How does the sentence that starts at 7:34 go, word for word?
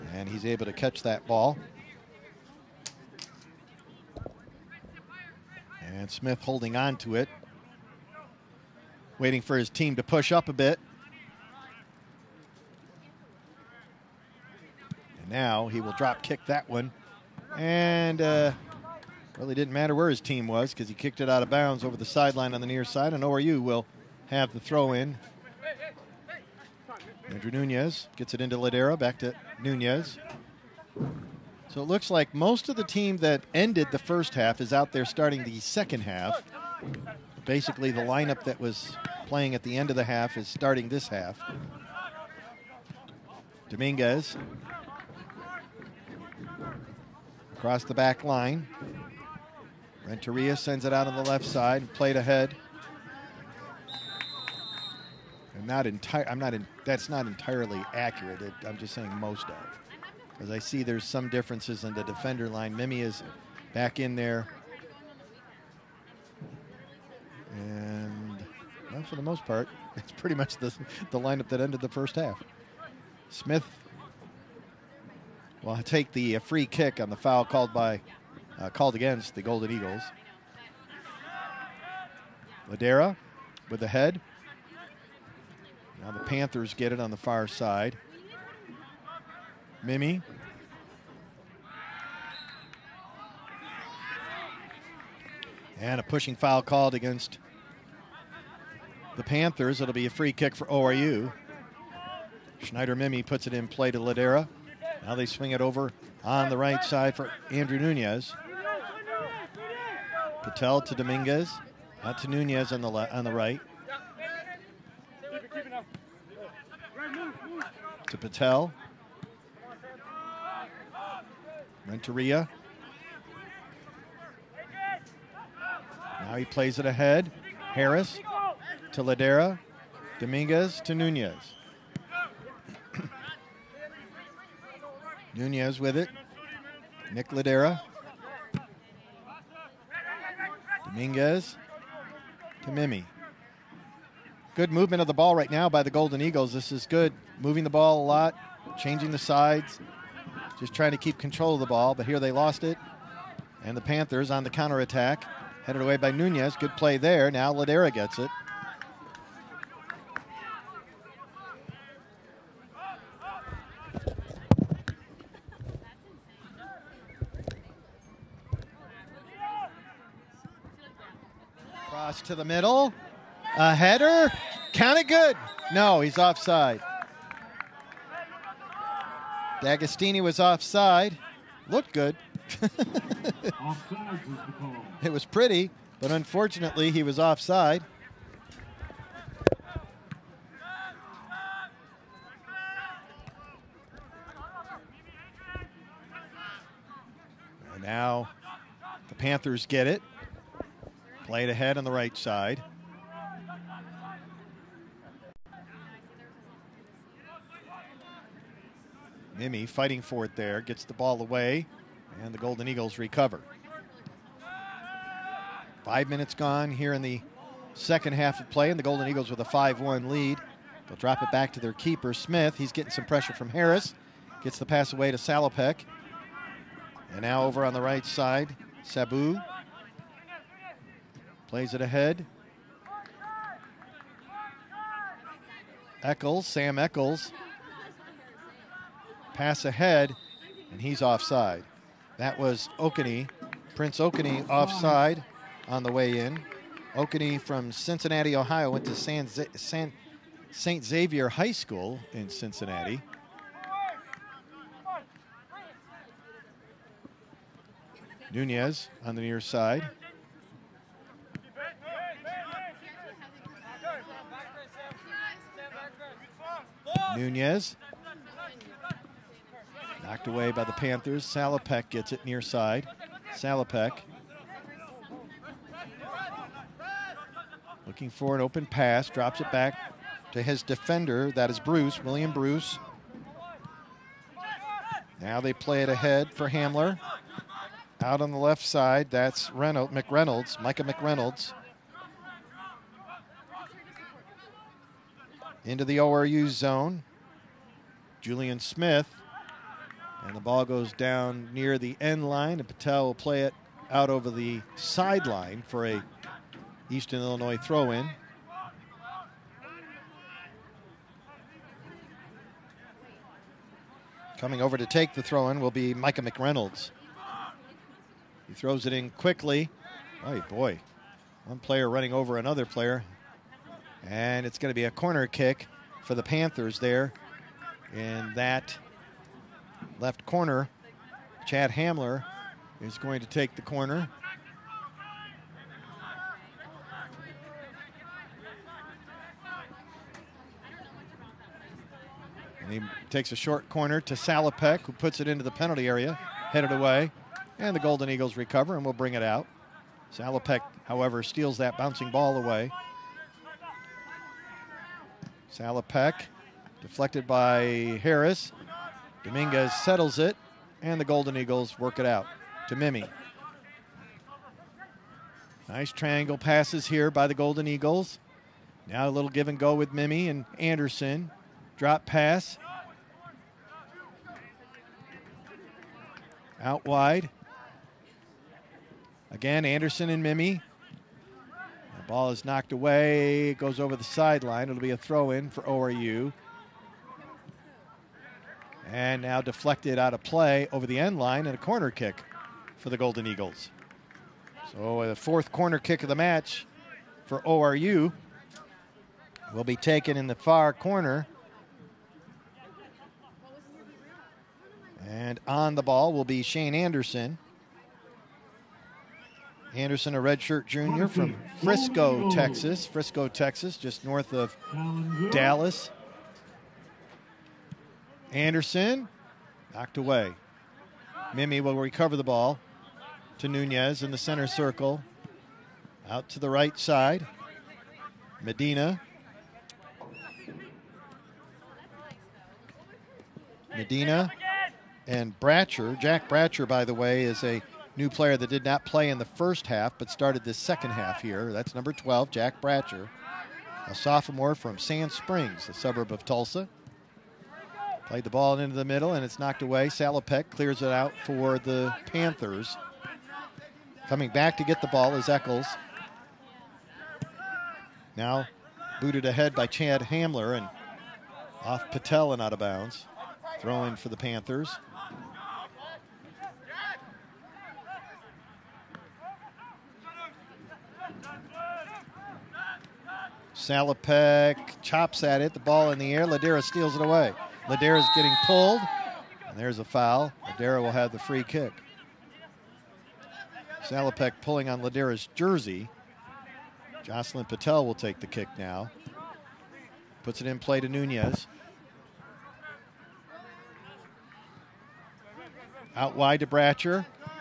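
Coming back to get the ball is Eccles.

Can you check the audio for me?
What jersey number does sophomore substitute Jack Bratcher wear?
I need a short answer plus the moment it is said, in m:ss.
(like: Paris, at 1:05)
12, at 7:21.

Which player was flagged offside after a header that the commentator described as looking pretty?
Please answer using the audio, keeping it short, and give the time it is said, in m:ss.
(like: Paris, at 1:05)
D'Agostini, at 2:59.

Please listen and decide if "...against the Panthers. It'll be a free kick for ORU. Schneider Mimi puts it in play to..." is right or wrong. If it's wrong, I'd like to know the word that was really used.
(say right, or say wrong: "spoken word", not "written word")
right.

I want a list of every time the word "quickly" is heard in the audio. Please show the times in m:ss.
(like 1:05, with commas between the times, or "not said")
5:19.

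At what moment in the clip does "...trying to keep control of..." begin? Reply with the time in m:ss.
2:30.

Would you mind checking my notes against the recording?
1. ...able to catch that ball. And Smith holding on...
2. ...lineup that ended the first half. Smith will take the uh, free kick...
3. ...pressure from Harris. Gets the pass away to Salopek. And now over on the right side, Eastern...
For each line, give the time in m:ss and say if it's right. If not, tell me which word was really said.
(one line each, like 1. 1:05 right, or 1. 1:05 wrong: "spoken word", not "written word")
1. 0:00 right
2. 1:11 right
3. 3:43 wrong: "Sabu", not "Eastern".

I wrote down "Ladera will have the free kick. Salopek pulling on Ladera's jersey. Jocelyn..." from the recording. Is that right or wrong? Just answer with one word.
right.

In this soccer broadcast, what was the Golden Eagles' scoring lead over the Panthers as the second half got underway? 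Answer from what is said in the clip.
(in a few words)
5-1.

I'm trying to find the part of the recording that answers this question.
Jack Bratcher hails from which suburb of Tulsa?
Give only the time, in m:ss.
7:24.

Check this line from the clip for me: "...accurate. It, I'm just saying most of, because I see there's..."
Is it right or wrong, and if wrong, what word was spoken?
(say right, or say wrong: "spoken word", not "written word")
right.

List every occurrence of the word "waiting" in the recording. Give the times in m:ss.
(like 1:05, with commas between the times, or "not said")
0:09.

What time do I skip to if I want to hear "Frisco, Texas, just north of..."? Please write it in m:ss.
6:52.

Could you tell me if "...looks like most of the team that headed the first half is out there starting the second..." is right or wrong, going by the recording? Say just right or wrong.
wrong.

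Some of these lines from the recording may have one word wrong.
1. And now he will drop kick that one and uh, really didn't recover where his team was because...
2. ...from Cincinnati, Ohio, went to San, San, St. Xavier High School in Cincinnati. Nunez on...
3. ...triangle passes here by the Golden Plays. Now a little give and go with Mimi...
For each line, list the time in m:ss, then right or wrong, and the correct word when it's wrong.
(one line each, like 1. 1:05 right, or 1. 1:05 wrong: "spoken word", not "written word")
1. 0:15 wrong: "matter", not "recover"
2. 4:07 right
3. 6:05 wrong: "Eagles", not "Plays".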